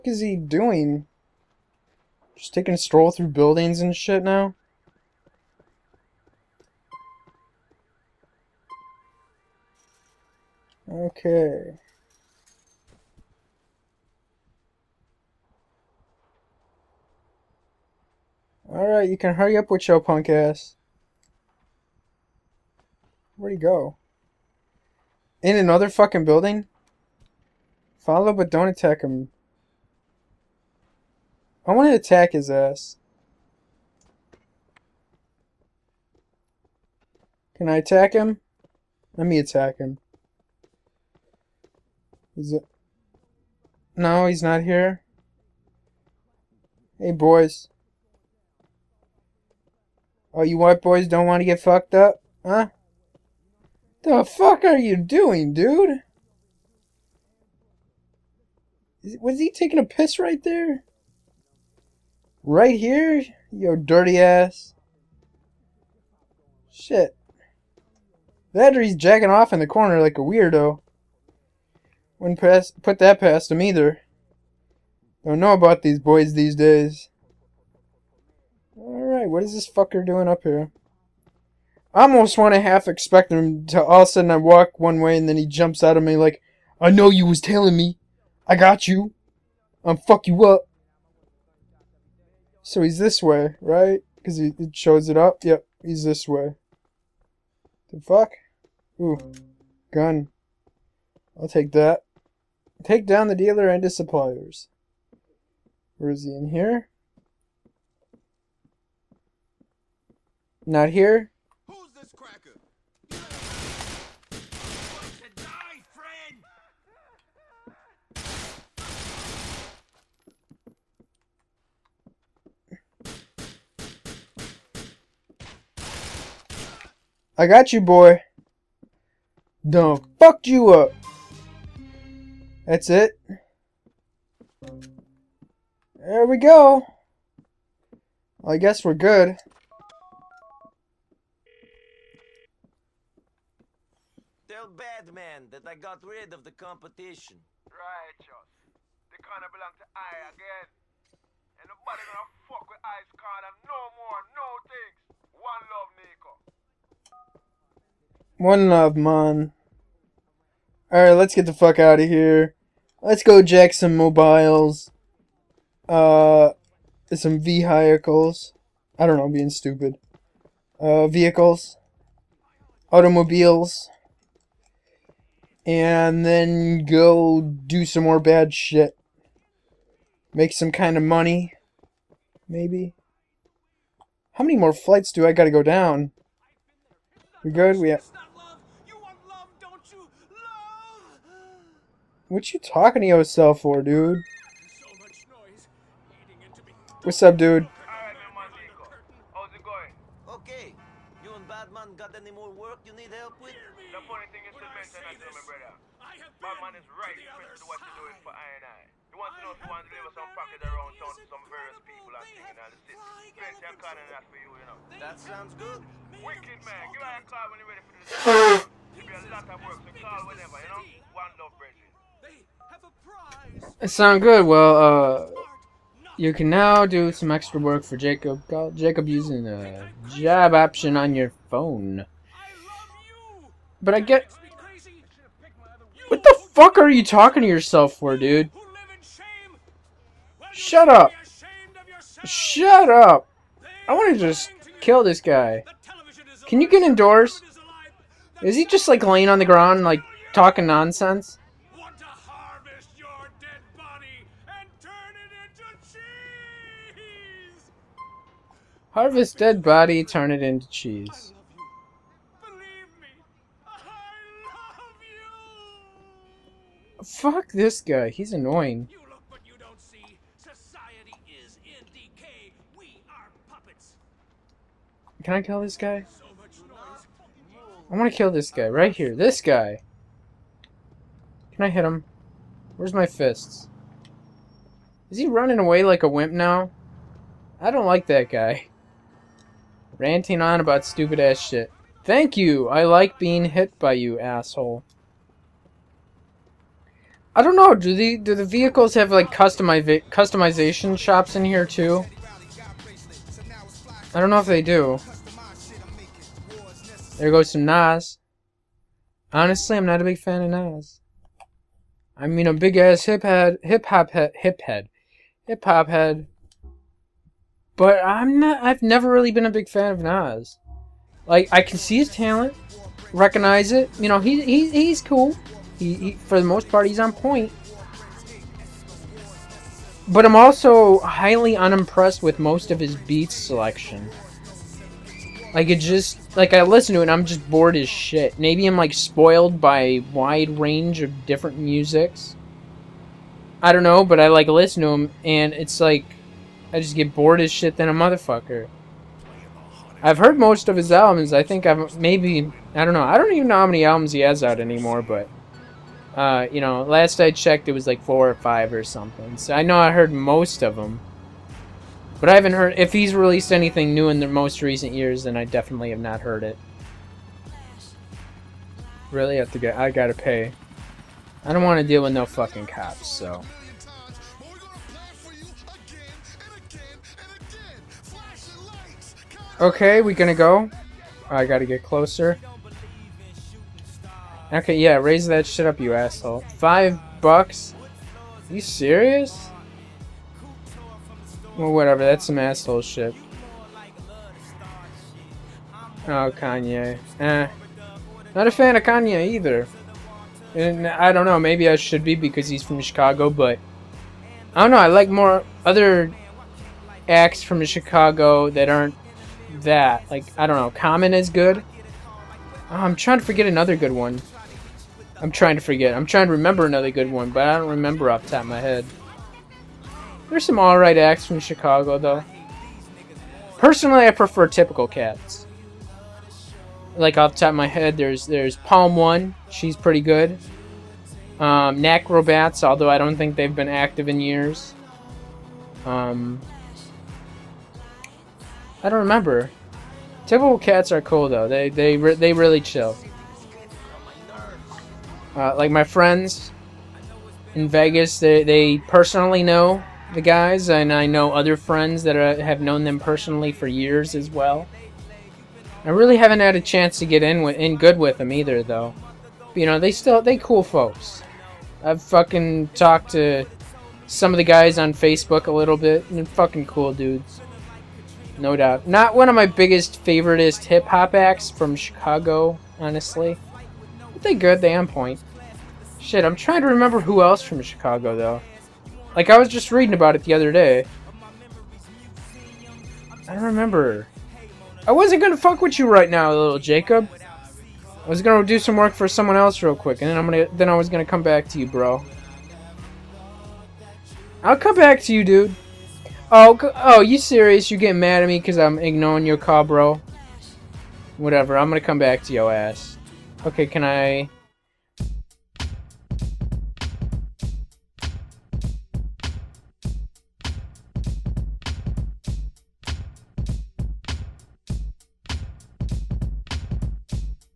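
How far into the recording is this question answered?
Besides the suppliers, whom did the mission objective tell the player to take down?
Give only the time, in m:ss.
1:43.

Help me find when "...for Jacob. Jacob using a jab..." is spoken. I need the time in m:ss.
3:47.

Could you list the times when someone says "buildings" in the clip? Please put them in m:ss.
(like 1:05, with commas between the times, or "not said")
0:03, 0:26.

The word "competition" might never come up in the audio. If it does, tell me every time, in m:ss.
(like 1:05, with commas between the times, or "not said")
2:26.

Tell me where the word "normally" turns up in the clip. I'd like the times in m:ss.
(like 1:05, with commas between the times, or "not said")
not said.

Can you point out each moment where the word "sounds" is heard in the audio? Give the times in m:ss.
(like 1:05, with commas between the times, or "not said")
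3:35, 3:43.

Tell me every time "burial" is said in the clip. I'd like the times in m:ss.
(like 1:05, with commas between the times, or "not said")
not said.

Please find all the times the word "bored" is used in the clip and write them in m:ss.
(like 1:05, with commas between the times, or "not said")
5:37, 5:47.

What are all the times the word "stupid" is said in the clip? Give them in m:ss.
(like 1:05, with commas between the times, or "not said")
2:49, 4:50.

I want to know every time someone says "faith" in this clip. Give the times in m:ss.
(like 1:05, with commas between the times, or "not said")
not said.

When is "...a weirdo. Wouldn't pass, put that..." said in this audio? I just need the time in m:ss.
1:10.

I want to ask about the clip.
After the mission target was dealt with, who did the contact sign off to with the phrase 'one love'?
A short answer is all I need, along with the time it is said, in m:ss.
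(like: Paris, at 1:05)
Nick, at 2:35.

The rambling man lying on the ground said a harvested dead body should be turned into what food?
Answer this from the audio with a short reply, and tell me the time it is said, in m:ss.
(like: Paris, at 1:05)
Cheese, at 4:20.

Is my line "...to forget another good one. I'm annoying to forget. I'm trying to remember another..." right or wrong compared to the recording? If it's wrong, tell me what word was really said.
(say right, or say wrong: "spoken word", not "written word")
wrong: "trying", not "annoying".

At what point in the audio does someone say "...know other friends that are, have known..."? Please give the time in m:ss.
7:31.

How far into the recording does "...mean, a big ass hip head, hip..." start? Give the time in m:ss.
5:12.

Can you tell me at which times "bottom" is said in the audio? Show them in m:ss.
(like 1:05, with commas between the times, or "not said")
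not said.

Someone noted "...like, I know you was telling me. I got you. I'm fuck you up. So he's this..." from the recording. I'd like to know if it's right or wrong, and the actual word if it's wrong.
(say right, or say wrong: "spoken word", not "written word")
right.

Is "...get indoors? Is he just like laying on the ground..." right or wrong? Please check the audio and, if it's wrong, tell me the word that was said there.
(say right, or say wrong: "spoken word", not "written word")
right.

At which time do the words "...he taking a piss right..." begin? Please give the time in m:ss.
0:59.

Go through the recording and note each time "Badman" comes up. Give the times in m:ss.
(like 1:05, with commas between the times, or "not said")
2:24, 3:21, 3:26.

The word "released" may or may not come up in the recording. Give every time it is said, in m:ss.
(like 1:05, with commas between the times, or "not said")
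6:03.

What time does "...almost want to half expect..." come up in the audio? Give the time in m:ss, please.
1:22.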